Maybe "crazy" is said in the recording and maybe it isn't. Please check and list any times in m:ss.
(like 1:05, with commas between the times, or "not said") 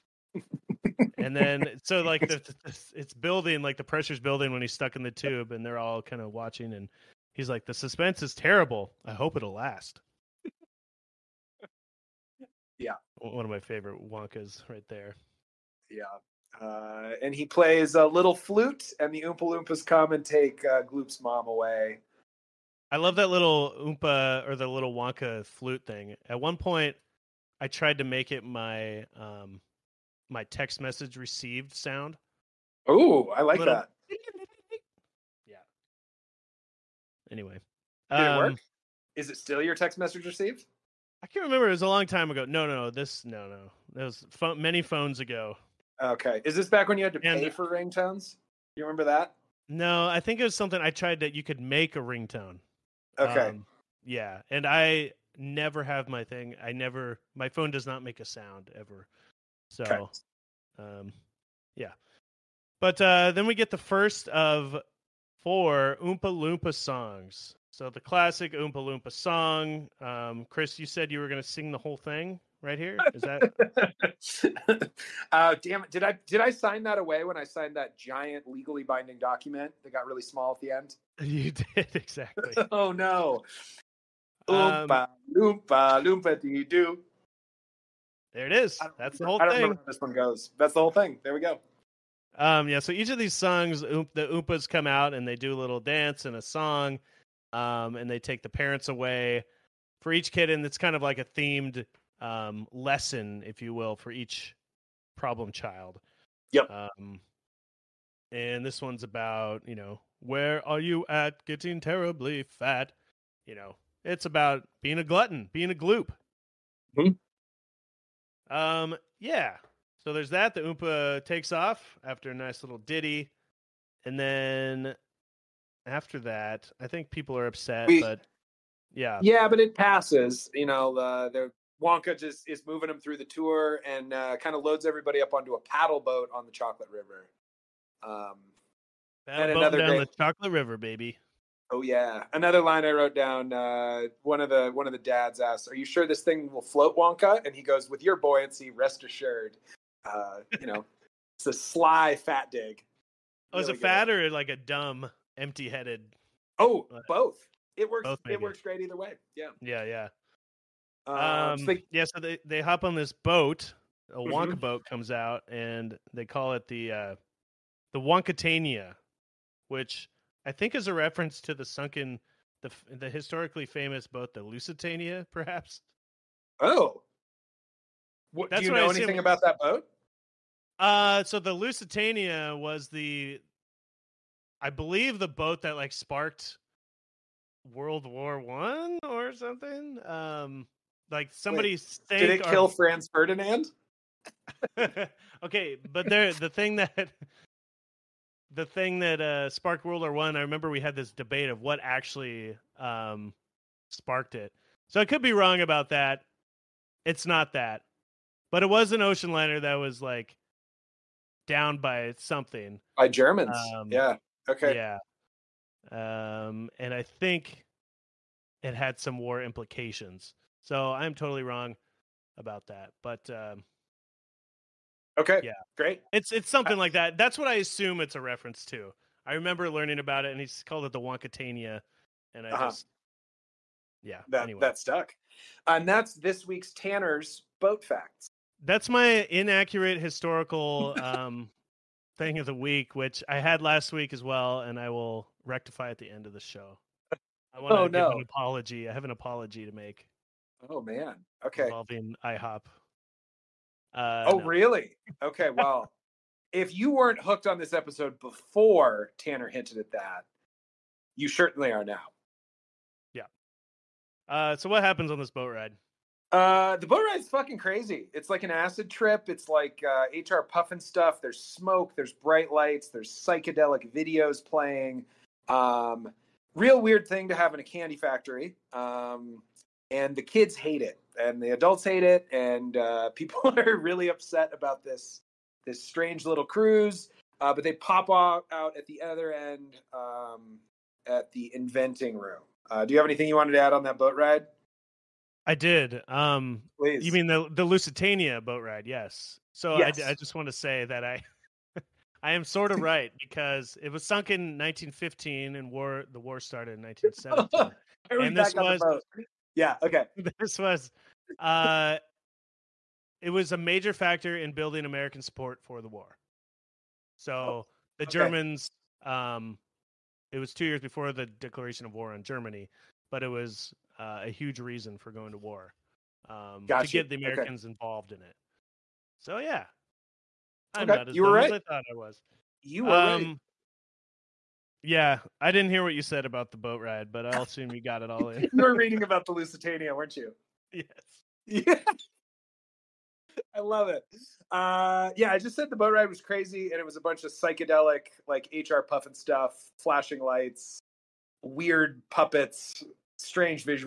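4:27, 5:46.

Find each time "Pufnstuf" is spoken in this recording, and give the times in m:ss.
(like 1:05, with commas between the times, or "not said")
4:30, 5:48.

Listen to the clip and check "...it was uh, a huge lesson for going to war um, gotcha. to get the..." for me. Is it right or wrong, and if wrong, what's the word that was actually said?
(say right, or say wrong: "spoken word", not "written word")
wrong: "reason", not "lesson".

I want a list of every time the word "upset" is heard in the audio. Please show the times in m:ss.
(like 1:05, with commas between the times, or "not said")
2:07, 4:44.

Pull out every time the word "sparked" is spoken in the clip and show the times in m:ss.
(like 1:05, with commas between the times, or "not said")
3:05, 3:19, 3:23.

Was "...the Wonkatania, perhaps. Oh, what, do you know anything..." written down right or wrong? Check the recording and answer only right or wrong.
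wrong.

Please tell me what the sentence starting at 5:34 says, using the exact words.
Yeah, I didn't hear what you said about the boat ride, but I'll assume you got it all in.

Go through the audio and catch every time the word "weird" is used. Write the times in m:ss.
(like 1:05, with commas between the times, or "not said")
4:36, 5:51.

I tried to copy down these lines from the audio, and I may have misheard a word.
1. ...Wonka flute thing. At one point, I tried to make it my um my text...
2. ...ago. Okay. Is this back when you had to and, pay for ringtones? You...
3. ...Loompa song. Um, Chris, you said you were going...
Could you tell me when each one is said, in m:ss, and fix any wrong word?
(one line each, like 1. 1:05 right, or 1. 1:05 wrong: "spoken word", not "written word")
1. 0:24 right
2. 0:45 right
3. 1:08 right.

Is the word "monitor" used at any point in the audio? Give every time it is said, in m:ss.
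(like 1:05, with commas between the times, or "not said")
not said.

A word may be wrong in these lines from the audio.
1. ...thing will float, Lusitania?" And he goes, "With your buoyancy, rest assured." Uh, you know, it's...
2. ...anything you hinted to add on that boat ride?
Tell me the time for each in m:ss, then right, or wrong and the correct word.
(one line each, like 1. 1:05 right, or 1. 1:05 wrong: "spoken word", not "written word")
1. 2:26 wrong: "Wonka", not "Lusitania"
2. 4:53 wrong: "wanted", not "hinted".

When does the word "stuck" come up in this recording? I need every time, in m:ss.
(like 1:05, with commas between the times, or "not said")
0:04, 3:54.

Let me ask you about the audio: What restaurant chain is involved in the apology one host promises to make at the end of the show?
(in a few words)
IHOP.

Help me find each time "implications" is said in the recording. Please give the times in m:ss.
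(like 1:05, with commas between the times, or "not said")
3:39.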